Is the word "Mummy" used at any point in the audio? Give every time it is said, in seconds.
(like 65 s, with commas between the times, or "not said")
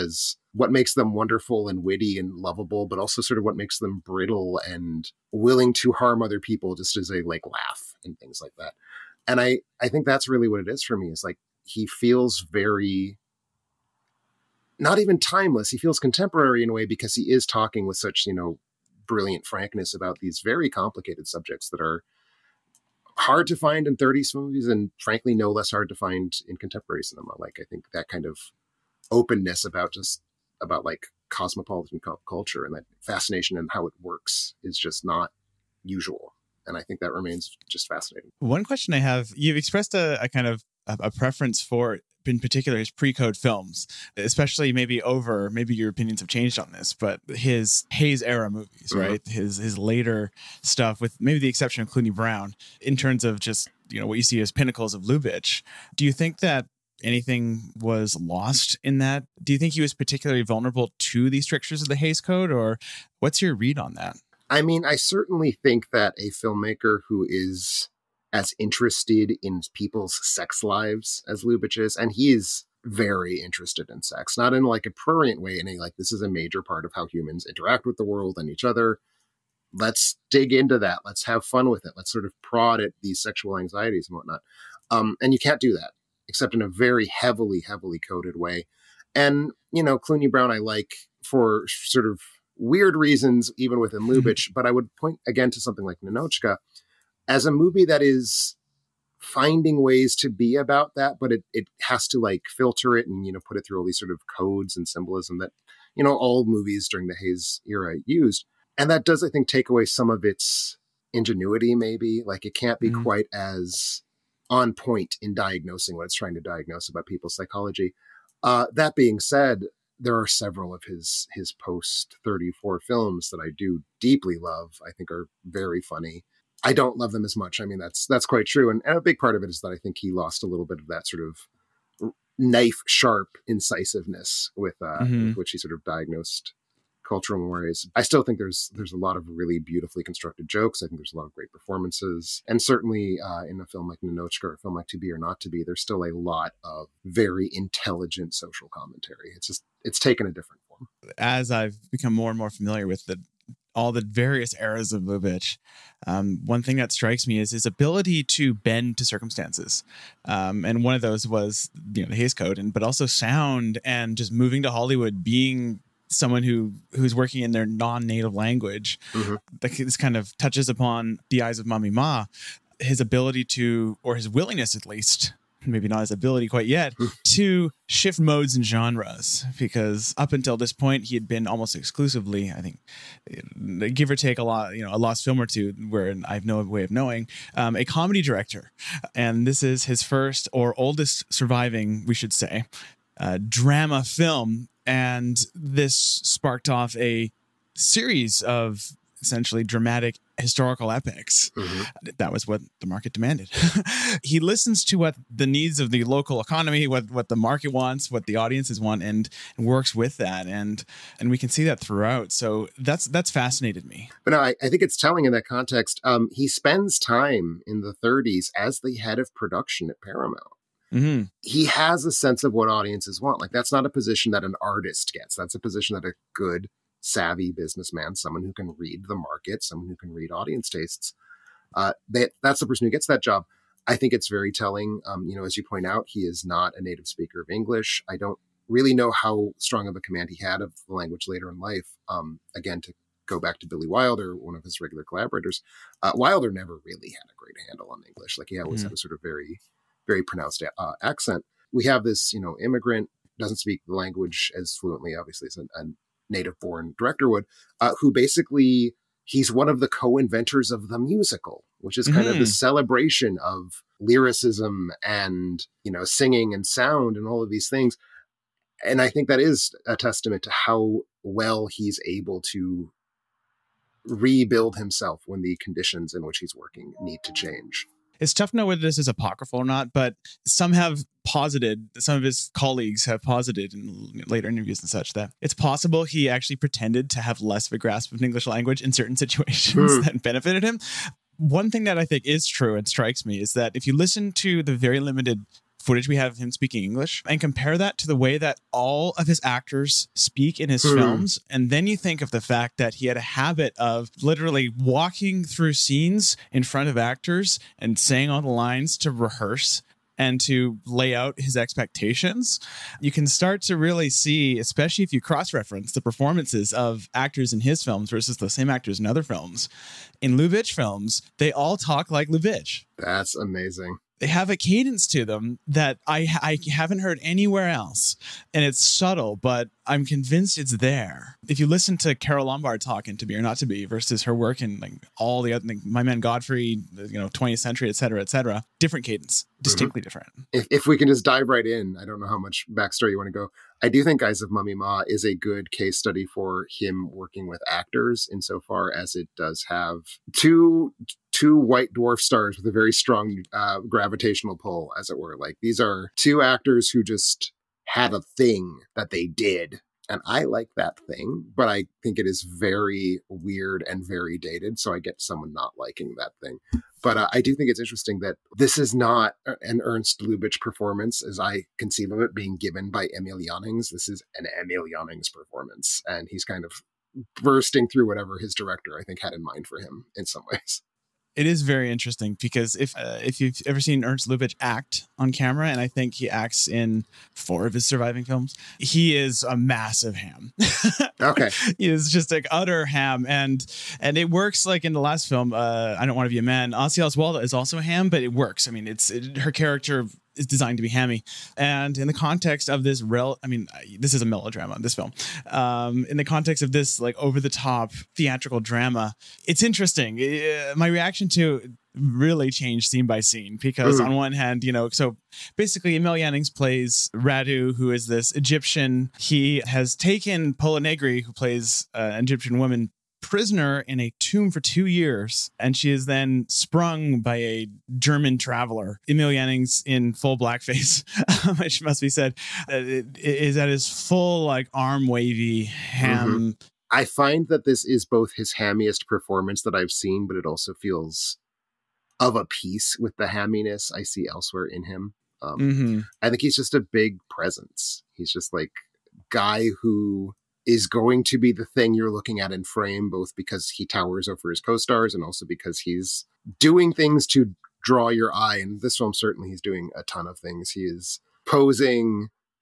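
171 s, 344 s.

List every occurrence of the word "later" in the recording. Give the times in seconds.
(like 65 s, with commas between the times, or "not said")
49 s, 241 s, 284 s.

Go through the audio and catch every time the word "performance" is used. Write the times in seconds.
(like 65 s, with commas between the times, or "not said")
141 s, 316 s, 370 s, 375 s, 439 s.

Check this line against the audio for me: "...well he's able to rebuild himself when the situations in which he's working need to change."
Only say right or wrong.
wrong.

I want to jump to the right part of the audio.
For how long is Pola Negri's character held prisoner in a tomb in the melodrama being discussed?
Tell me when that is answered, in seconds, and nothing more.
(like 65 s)
424 s.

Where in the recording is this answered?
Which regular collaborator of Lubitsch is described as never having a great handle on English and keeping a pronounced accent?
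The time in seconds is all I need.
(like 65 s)
243 s.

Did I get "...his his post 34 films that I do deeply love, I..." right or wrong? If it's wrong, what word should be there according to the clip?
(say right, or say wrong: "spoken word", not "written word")
right.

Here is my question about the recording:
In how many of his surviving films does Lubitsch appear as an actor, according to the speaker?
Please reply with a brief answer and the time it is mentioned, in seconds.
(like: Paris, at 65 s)
4, at 387 s.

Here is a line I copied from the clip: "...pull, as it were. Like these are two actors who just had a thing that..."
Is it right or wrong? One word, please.
right.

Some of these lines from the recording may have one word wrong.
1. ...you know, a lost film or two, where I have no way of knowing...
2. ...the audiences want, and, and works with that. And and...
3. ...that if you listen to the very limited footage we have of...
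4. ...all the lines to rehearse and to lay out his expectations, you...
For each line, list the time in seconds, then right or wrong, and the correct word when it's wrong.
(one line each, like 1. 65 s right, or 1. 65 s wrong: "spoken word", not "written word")
1. 184 s right
2. 208 s right
3. 293 s right
4. 308 s right.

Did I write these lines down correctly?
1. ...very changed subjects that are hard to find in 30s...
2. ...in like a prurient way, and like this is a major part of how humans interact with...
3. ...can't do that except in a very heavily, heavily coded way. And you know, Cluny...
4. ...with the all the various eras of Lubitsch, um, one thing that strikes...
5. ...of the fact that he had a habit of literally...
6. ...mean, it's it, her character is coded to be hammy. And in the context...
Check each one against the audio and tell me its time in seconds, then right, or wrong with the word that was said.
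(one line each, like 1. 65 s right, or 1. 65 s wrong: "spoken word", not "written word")
1. 20 s wrong: "complicated", not "changed"
2. 74 s right
3. 85 s right
4. 152 s right
5. 302 s right
6. 398 s wrong: "designed", not "coded".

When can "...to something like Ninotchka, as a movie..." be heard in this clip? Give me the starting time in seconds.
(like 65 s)
95 s.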